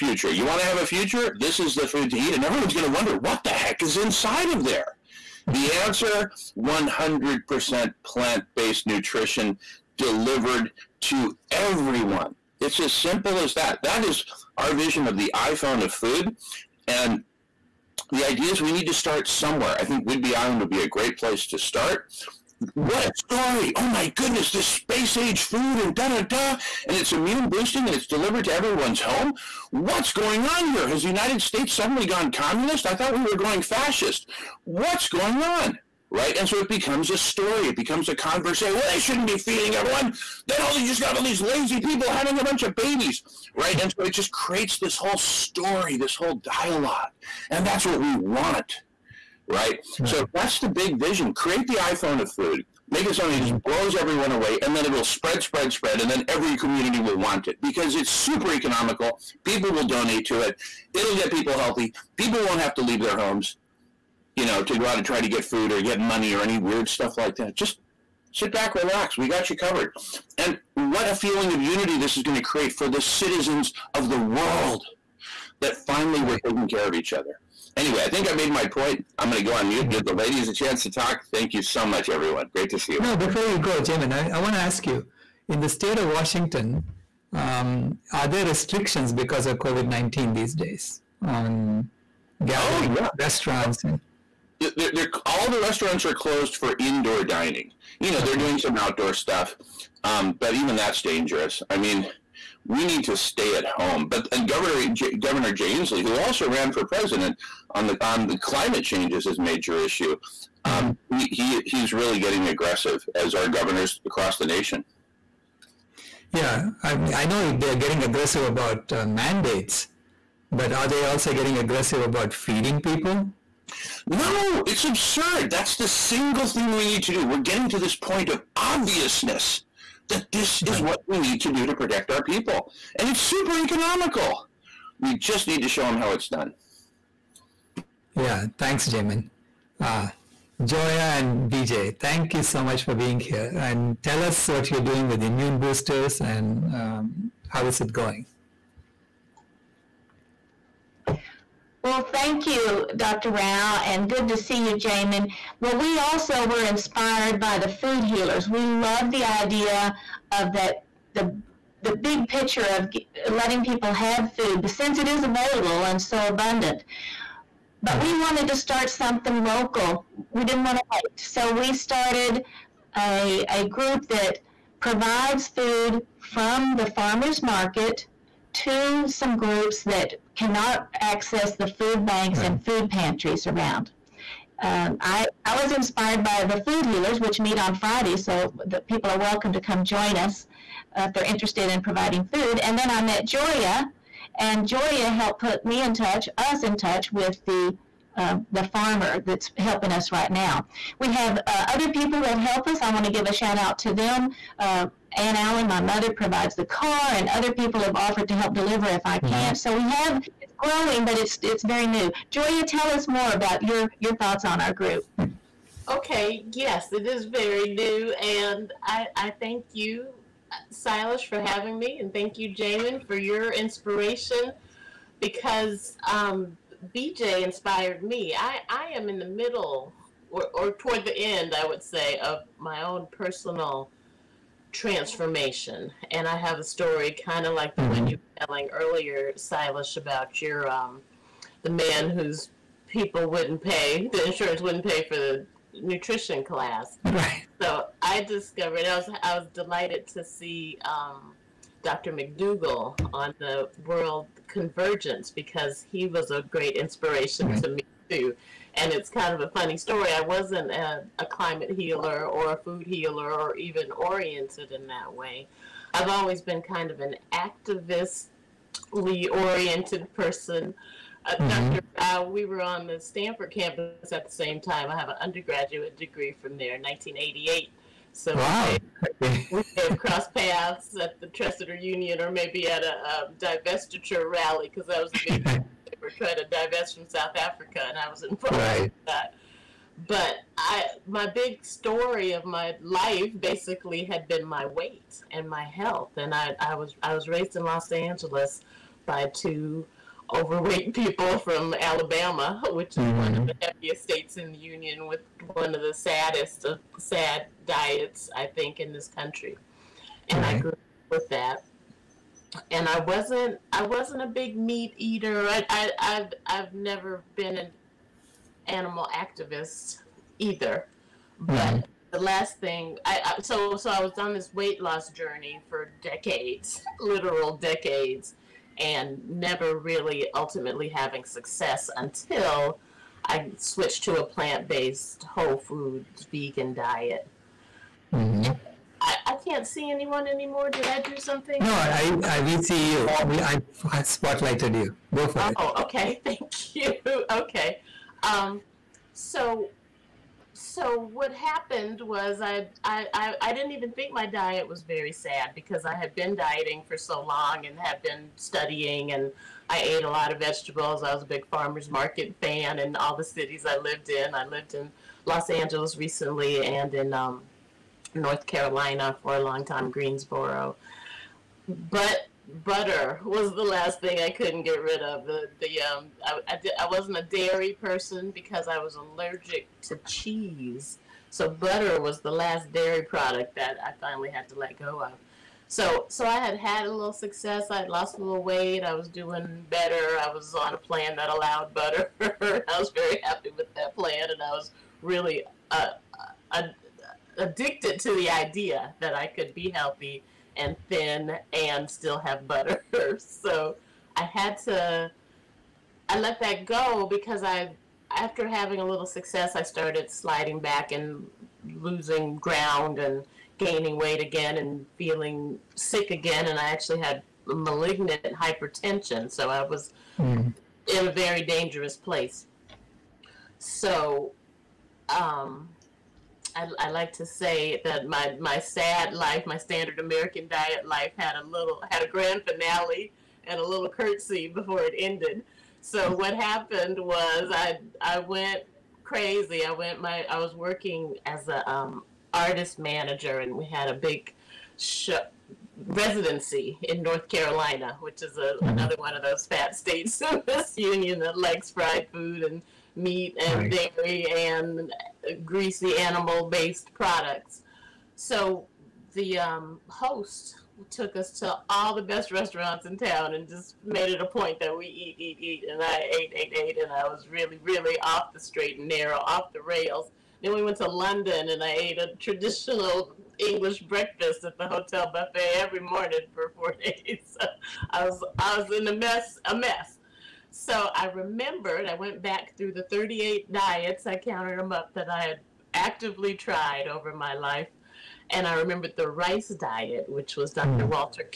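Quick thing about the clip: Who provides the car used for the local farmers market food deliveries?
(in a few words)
Aunt Allen.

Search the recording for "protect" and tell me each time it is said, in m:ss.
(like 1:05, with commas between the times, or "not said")
2:11.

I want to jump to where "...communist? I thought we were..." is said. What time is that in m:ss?
0:32.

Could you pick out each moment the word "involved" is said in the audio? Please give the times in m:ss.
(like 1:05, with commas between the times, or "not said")
4:48.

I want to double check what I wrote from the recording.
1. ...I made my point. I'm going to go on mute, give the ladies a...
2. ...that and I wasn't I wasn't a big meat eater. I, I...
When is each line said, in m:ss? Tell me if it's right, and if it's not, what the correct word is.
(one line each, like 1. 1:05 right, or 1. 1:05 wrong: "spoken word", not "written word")
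1. 1:18 right
2. 5:11 right.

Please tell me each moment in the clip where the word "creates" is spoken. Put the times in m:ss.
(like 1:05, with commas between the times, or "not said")
0:44, 0:51, 1:12.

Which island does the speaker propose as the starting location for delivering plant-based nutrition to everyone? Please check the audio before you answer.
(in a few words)
Whidbey Island.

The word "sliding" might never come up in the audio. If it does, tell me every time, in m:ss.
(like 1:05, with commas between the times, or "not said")
6:50.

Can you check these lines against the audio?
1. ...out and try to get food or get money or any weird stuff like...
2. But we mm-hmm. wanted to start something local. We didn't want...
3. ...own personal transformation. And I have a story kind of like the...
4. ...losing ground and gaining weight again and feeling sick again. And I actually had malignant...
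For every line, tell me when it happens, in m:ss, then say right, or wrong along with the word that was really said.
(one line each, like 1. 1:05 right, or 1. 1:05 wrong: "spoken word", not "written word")
1. 1:04 right
2. 2:47 right
3. 3:52 right
4. 6:51 right.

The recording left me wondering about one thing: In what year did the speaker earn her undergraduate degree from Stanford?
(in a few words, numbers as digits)
1988.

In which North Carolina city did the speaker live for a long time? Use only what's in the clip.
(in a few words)
Greensboro.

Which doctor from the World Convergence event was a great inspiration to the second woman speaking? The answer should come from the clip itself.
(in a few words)
Dr. McDougall.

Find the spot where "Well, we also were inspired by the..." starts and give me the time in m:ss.
2:35.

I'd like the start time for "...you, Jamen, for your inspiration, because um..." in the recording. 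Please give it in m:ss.
3:42.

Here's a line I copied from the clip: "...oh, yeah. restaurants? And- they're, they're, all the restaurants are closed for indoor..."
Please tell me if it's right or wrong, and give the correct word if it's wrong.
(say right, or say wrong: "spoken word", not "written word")
right.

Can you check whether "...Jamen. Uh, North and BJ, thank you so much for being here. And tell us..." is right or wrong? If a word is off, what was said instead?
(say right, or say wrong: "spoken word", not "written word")
wrong: "Joya", not "North".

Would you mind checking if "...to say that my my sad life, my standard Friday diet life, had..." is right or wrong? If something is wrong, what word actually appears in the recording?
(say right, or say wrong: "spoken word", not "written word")
wrong: "American", not "Friday".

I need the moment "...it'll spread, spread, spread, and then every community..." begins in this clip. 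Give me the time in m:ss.
0:54.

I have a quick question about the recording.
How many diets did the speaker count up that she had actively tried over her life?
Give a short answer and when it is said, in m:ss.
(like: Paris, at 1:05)
38, at 8:02.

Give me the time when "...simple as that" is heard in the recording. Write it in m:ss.
0:12.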